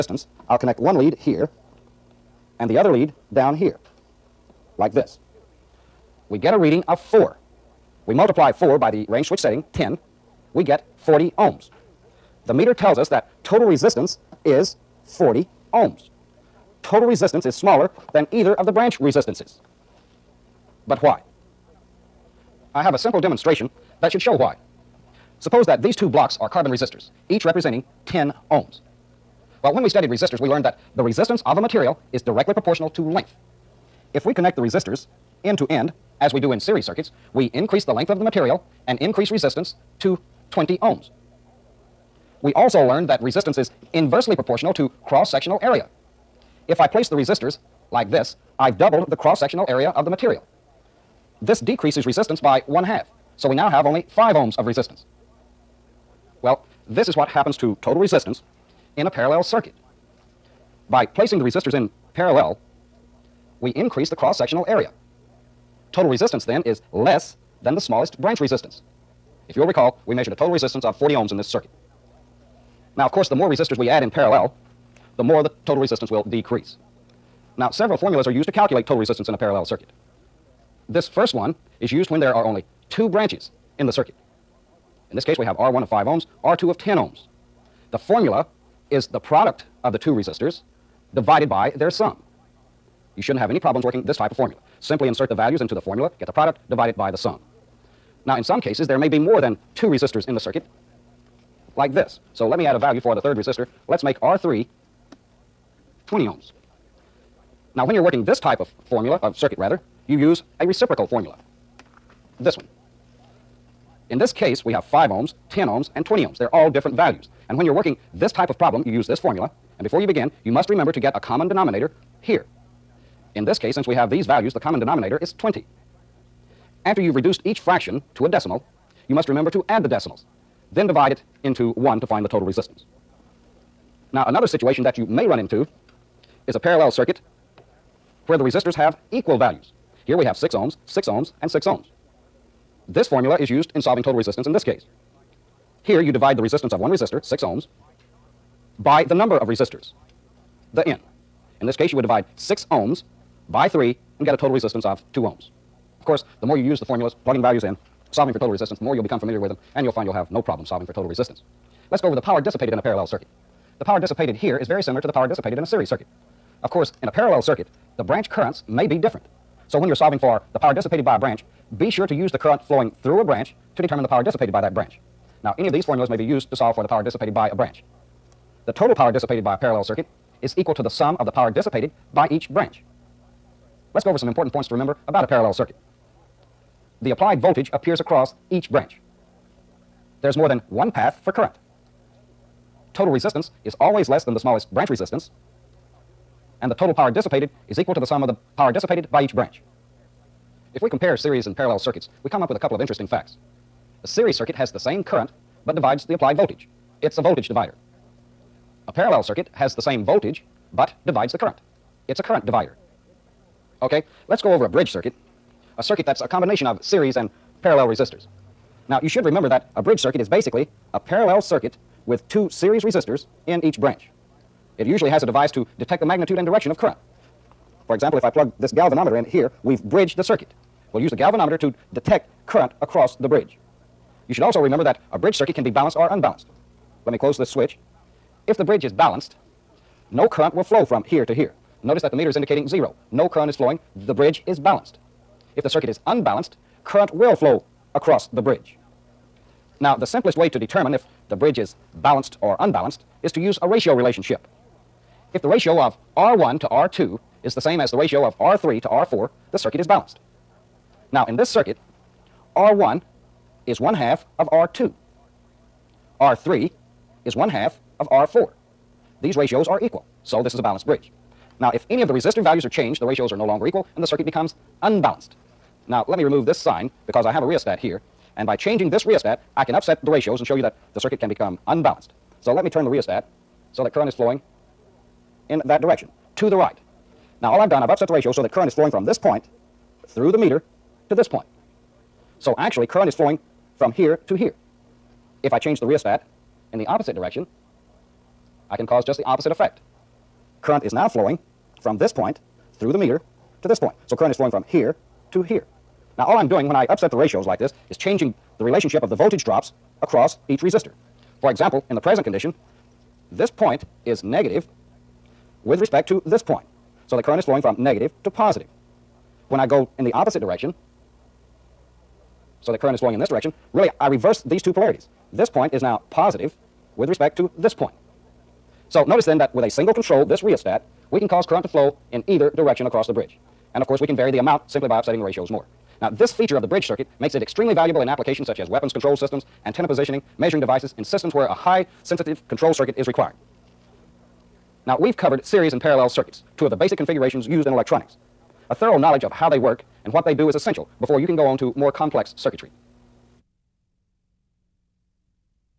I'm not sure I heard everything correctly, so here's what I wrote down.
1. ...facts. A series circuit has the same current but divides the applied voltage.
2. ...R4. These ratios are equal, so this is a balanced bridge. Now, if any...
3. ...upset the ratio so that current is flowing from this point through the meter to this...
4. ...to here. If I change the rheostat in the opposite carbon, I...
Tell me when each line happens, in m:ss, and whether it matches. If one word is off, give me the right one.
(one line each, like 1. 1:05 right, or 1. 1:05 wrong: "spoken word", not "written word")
1. 3:23 right
2. 4:28 right
3. 4:47 right
4. 4:54 wrong: "direction", not "carbon".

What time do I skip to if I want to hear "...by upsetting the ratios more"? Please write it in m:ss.
5:34.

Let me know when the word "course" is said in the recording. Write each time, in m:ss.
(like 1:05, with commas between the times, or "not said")
1:13, 2:36, 2:46, 5:33.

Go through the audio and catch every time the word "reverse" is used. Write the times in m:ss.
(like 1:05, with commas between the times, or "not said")
5:24.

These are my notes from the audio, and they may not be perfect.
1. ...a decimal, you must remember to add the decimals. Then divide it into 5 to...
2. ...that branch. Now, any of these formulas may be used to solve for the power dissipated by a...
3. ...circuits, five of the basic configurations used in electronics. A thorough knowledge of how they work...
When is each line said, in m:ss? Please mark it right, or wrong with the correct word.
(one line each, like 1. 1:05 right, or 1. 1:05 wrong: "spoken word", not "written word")
1. 2:08 wrong: "1", not "5"
2. 2:54 right
3. 5:46 wrong: "two", not "five".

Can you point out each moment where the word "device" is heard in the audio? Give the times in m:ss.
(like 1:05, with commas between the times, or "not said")
3:45, 5:40.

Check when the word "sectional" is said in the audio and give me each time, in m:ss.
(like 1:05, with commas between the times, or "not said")
0:45, 0:49, 1:04.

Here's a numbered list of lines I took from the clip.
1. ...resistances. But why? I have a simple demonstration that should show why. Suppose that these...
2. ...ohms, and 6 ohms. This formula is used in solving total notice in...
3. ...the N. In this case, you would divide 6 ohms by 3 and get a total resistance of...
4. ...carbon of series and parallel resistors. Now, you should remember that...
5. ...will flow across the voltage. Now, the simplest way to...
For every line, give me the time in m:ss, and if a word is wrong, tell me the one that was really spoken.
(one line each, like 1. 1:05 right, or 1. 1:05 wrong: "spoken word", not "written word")
1. 0:18 right
2. 2:21 wrong: "resistance", not "notice"
3. 2:30 right
4. 3:36 wrong: "combination", not "carbon"
5. 4:07 wrong: "bridge", not "voltage".